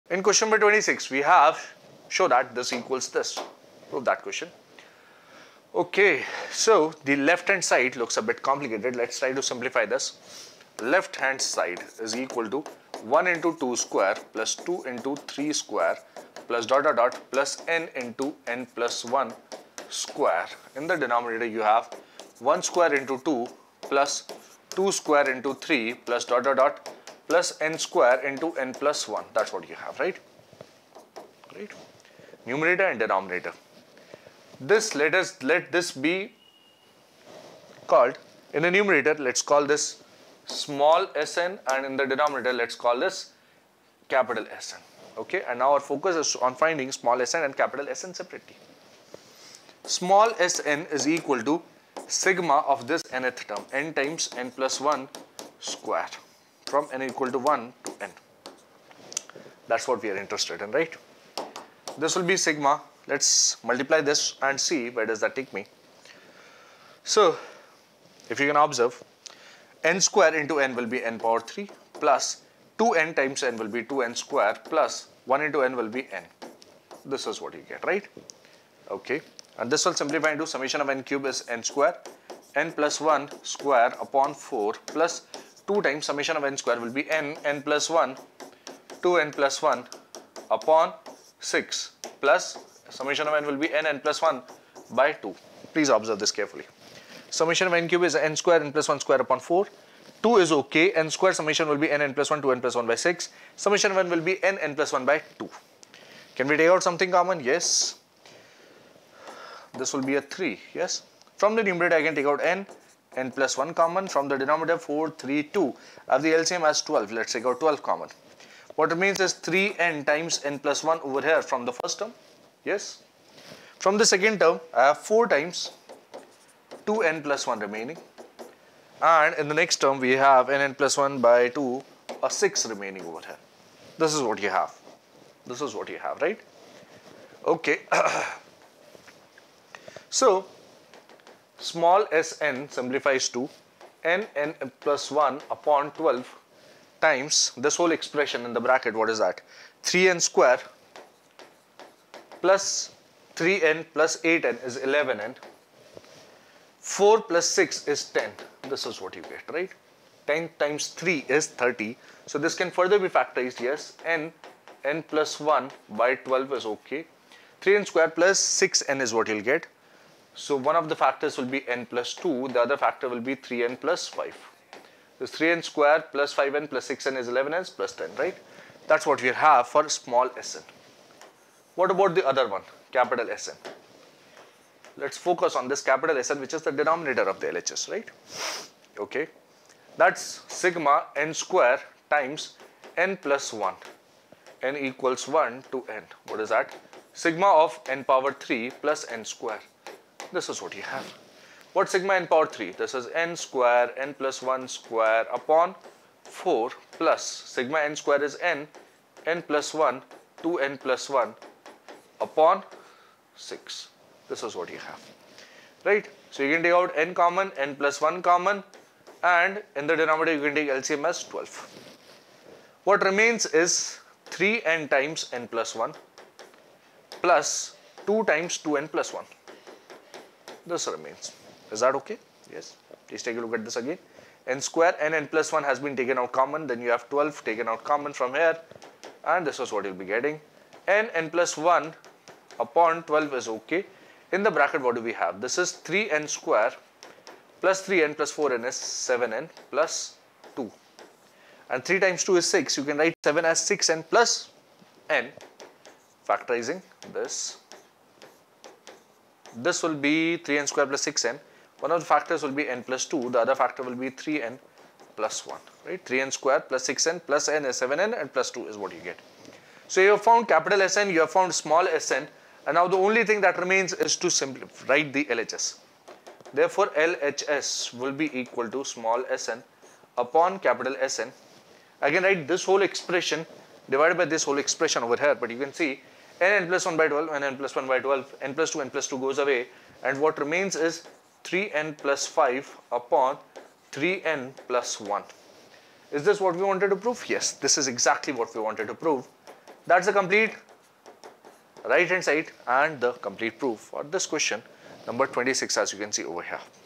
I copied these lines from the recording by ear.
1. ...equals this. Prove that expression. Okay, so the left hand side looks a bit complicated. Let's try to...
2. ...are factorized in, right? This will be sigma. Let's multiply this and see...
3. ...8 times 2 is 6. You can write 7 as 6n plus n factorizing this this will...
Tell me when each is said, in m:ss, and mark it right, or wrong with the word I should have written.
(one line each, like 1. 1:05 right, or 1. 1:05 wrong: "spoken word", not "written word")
1. 0:02 wrong: "question", not "expression"
2. 1:00 wrong: "interested", not "factorized"
3. 4:11 wrong: "3", not "8".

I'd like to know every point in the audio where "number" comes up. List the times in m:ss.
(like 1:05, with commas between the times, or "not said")
0:00, 5:05.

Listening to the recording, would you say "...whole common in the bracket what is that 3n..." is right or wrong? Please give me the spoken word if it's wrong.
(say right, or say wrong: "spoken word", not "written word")
wrong: "expression", not "common".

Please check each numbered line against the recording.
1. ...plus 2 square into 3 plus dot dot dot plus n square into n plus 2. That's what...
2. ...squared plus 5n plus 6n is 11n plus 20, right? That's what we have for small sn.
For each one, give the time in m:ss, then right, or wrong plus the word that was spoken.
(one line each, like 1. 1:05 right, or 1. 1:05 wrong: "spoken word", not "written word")
1. 0:23 wrong: "1", not "2"
2. 2:55 wrong: "10", not "20".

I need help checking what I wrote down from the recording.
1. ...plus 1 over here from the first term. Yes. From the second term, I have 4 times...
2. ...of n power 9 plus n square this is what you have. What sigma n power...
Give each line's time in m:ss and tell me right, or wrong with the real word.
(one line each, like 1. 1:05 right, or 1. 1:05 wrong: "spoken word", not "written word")
1. 2:00 right
2. 3:17 wrong: "3", not "9".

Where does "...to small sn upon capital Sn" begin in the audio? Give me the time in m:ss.
4:38.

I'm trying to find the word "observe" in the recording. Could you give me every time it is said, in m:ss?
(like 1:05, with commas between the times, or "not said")
1:08, 1:35.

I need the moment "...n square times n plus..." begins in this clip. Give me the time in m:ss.
3:11.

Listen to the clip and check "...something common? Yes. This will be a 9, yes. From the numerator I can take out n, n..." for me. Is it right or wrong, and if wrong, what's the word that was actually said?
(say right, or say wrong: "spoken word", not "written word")
wrong: "3", not "9".